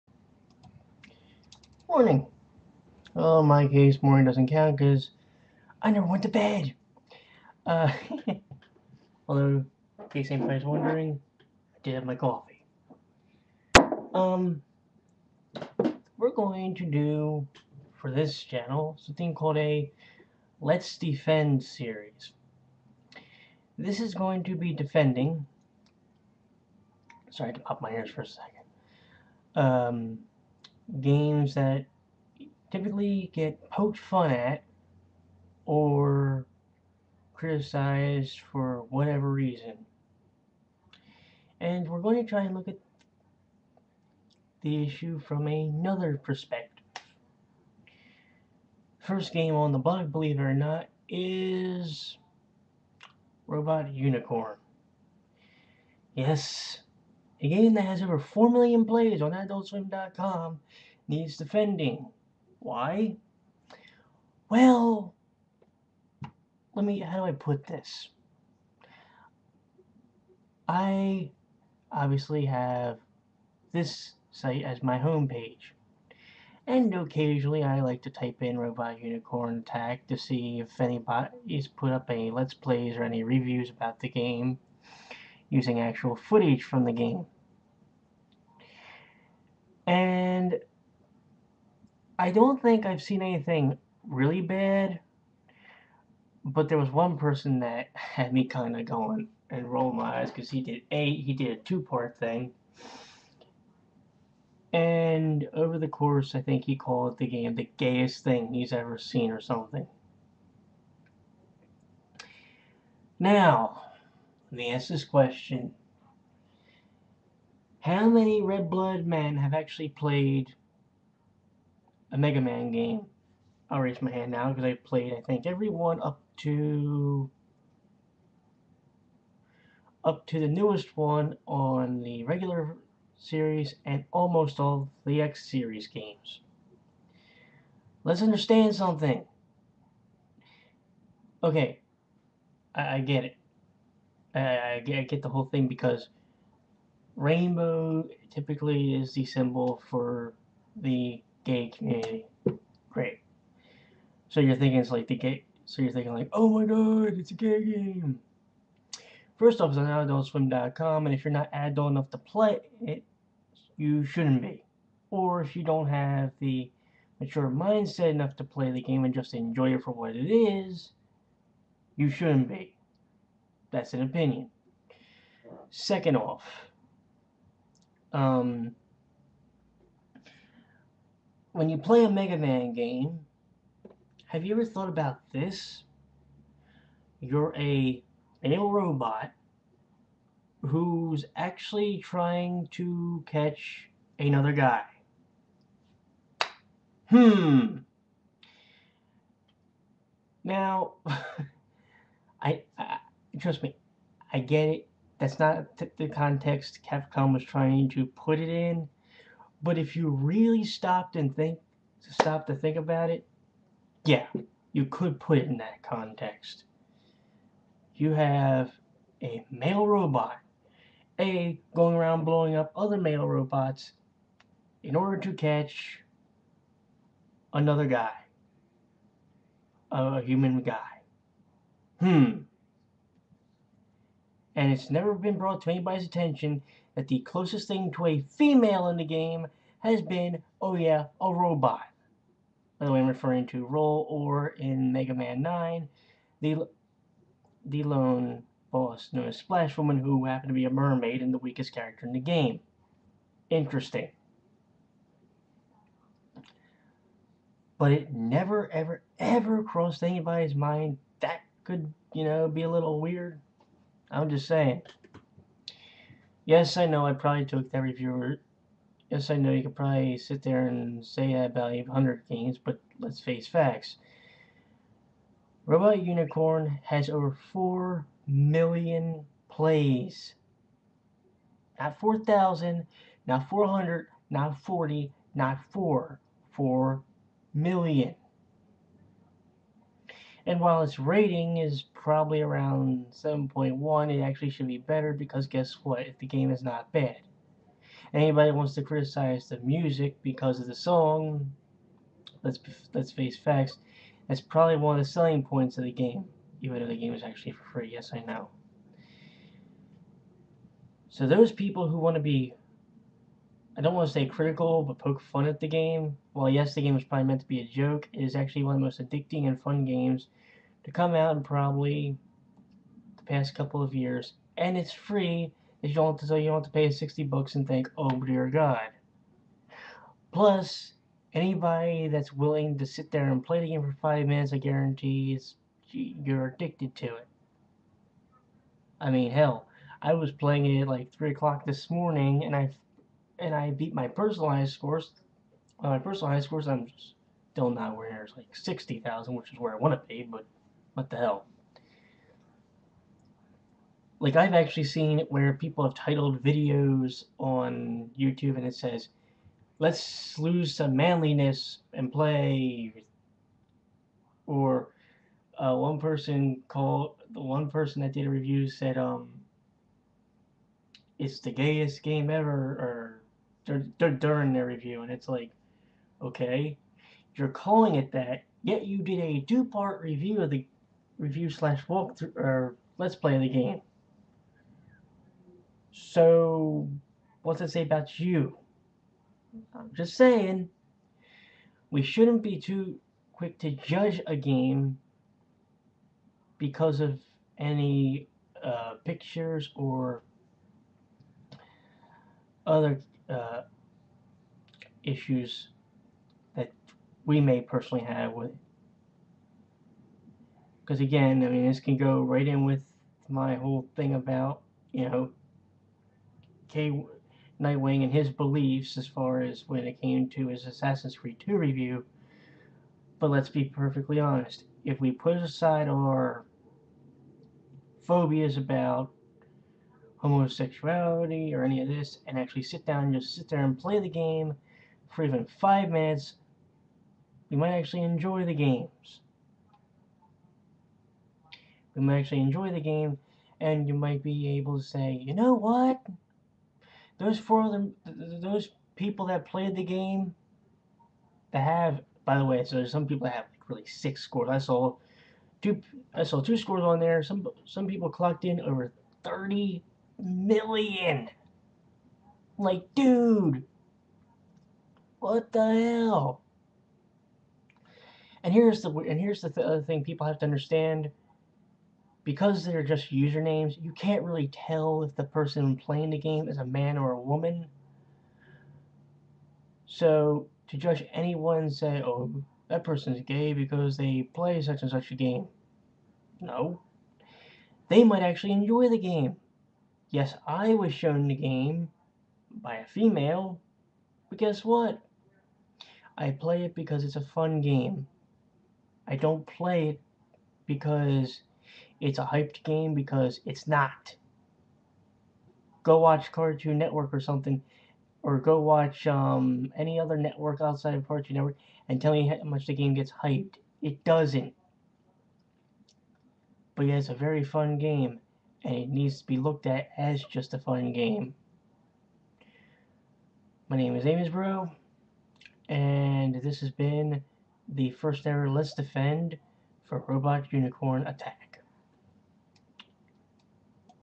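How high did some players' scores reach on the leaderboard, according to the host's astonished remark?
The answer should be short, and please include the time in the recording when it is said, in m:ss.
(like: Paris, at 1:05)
over 30 million, at 7:38.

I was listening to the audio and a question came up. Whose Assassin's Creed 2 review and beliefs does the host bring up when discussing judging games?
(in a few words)
K Nightwing.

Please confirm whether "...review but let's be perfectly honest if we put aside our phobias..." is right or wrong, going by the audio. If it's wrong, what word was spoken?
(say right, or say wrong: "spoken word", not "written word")
right.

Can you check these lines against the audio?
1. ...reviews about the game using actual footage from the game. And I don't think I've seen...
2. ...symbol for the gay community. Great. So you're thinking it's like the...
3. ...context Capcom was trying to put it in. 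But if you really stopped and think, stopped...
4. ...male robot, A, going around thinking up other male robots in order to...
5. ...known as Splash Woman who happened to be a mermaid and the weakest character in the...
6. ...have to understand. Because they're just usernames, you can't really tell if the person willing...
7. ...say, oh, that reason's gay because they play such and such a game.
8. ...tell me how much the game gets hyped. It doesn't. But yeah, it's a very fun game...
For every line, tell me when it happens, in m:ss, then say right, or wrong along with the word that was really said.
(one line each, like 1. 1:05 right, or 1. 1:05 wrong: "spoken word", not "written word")
1. 1:23 right
2. 2:29 right
3. 3:26 right
4. 3:39 wrong: "blowing", not "thinking"
5. 4:09 right
6. 7:50 wrong: "playing", not "willing"
7. 8:01 wrong: "person", not "reason"
8. 8:32 right.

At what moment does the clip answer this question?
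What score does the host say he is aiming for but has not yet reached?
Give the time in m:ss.
5:48.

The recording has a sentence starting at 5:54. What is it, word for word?
Like, I've actually seen where people have titled videos on YouTube and it says, let's lose some manliness and play.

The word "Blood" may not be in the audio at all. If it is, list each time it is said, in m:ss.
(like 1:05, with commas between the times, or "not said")
1:58.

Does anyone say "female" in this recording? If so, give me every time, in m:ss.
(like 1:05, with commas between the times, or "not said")
3:58, 8:12.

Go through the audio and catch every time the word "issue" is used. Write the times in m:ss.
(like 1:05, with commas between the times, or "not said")
0:44, 6:45.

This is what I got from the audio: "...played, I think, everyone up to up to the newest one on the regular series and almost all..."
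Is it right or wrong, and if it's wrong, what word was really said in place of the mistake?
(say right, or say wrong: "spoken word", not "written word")
right.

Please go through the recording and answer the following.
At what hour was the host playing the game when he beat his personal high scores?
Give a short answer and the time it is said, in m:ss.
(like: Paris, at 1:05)
3 o'clock, at 5:41.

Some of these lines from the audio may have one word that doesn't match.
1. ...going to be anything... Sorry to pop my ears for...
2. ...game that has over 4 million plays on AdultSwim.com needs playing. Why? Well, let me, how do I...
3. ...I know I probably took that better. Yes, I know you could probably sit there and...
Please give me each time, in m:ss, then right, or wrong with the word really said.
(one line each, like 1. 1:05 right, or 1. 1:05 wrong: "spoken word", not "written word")
1. 0:24 wrong: "defending", not "anything"
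2. 0:57 wrong: "defending", not "playing"
3. 4:26 wrong: "reviewer", not "better".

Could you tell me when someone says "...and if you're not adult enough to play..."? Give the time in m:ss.
2:41.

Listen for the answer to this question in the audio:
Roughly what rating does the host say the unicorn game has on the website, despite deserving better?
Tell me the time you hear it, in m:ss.
4:53.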